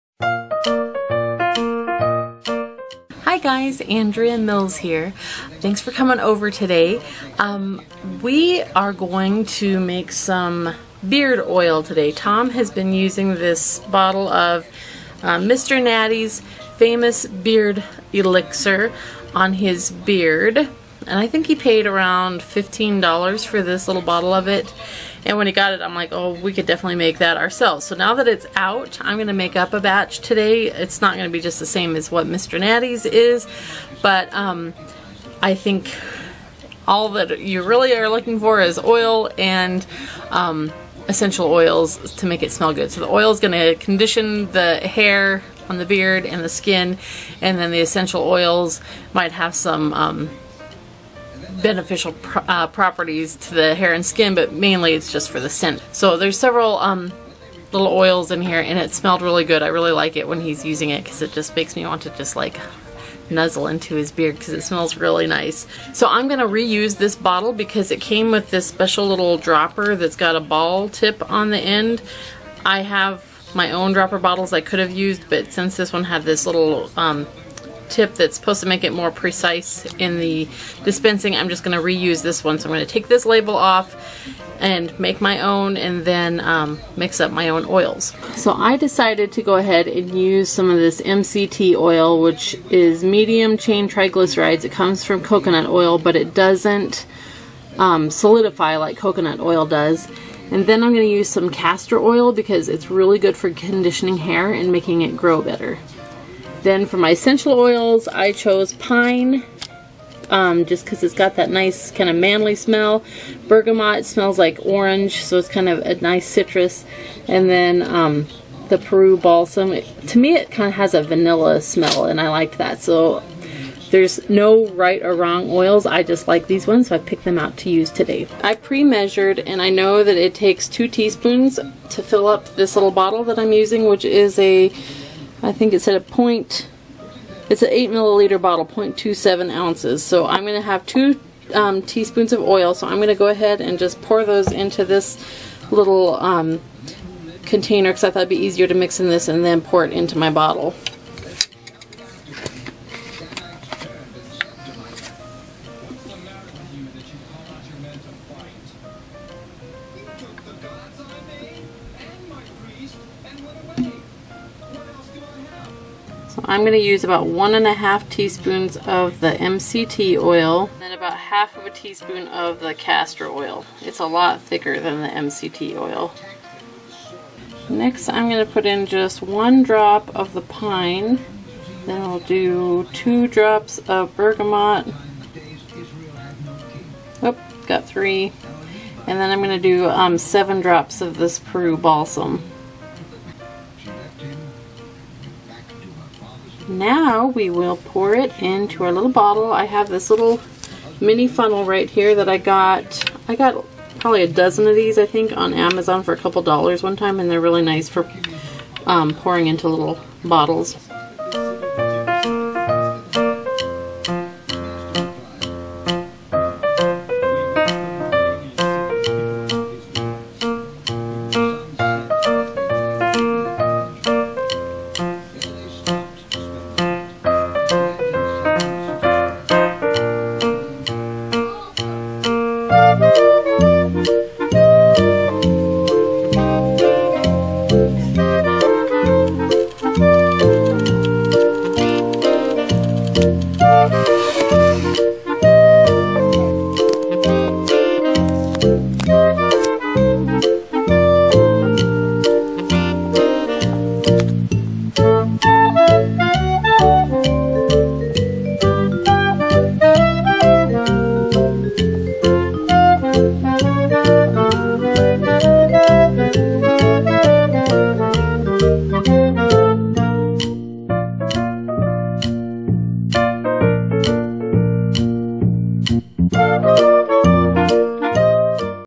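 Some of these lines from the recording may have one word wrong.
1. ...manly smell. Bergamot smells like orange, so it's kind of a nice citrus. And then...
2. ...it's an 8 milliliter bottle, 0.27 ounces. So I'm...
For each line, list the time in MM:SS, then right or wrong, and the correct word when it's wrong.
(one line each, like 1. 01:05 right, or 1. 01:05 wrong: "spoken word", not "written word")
1. 01:52 right
2. 02:17 right.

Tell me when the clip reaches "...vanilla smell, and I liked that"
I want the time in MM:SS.
02:01.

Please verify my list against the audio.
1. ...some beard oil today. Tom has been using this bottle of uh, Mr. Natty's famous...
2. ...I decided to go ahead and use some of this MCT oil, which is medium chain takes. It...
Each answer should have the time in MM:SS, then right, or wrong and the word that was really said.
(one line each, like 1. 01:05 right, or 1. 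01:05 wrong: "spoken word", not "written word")
1. 00:10 right
2. 01:28 wrong: "triglycerides", not "takes".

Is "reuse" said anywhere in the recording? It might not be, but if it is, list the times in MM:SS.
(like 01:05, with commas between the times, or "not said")
01:06, 01:21.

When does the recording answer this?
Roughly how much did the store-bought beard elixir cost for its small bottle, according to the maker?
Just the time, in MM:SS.
00:22.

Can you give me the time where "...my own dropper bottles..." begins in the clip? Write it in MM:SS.
01:13.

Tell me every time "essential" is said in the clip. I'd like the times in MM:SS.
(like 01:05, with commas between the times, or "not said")
00:41, 00:47, 01:47.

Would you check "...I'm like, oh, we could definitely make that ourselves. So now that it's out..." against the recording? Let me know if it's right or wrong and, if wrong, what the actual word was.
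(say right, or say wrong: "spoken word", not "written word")
right.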